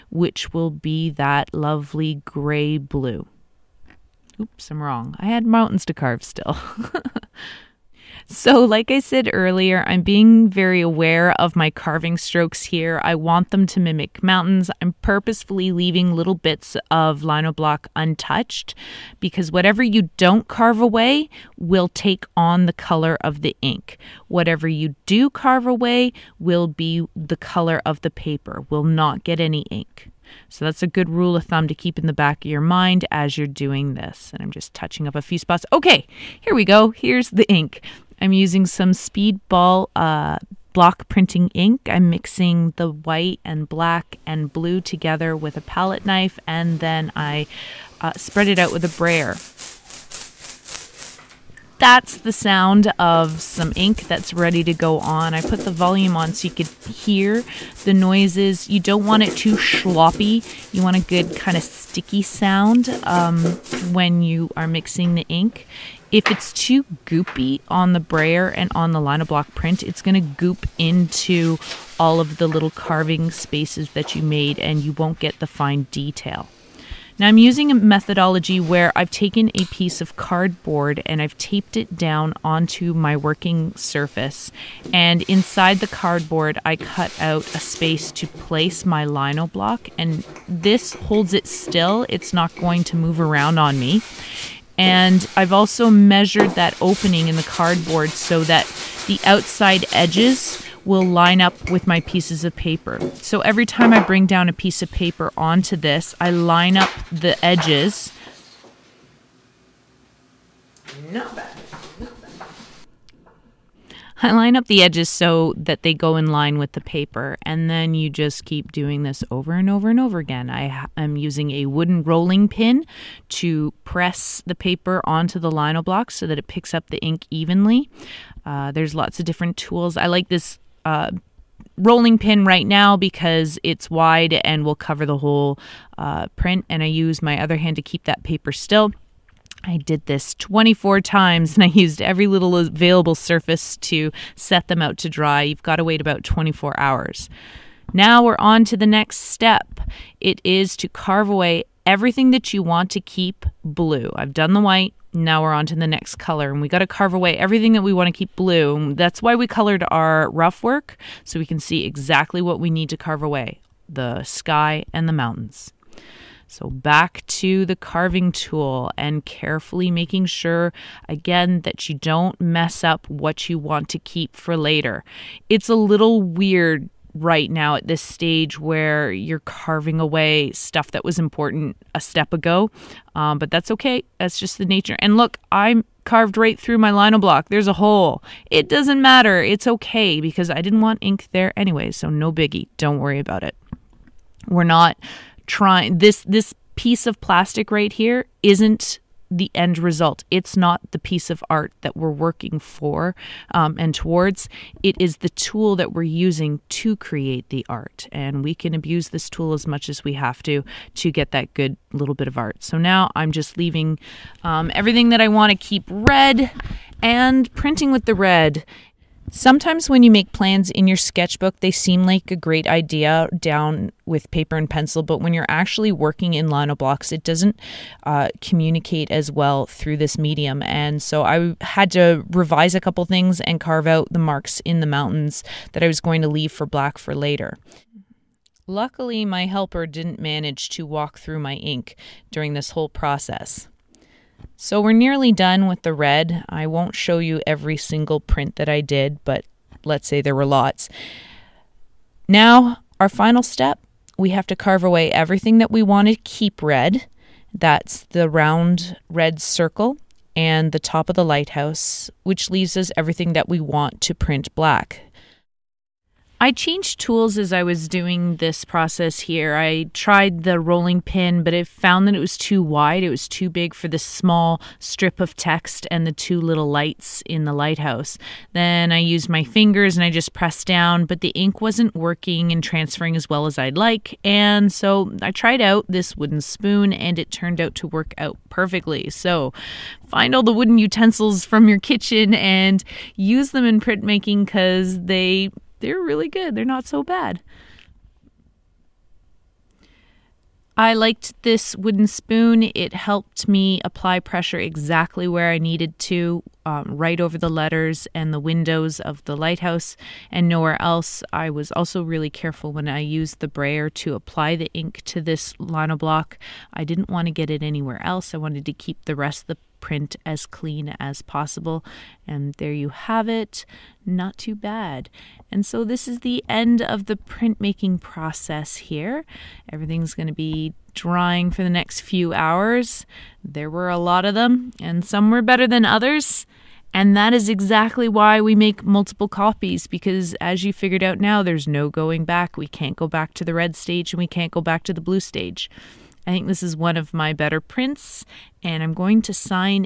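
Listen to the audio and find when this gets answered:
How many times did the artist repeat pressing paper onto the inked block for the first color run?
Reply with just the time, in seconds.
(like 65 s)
140 s.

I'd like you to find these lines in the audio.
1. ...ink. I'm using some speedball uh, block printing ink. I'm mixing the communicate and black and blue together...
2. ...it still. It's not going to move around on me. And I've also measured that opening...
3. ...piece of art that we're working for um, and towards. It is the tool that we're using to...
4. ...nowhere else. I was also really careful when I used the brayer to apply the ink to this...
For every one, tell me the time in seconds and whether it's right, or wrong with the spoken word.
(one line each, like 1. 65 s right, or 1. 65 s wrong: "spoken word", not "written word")
1. 37 s wrong: "white", not "communicate"
2. 91 s right
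3. 200 s right
4. 310 s right.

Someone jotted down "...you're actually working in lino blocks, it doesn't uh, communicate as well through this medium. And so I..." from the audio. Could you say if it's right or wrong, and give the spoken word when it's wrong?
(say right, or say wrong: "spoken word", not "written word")
right.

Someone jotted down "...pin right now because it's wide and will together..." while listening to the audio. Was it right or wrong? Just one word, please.
wrong.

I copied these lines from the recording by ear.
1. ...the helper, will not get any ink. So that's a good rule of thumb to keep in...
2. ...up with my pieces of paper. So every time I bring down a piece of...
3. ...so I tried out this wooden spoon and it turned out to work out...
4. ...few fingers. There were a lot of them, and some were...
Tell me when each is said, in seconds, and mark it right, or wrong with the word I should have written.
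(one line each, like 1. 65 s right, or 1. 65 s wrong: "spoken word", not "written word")
1. 28 s wrong: "paper", not "helper"
2. 101 s right
3. 284 s right
4. 331 s wrong: "hours", not "fingers".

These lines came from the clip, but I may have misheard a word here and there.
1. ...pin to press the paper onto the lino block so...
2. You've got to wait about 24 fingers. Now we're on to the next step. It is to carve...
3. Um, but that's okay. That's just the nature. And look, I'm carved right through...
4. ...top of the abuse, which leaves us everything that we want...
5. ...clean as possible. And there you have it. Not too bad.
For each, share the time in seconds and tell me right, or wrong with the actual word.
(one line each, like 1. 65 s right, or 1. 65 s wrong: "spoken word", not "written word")
1. 122 s right
2. 145 s wrong: "hours", not "fingers"
3. 183 s right
4. 260 s wrong: "lighthouse", not "abuse"
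5. 320 s right.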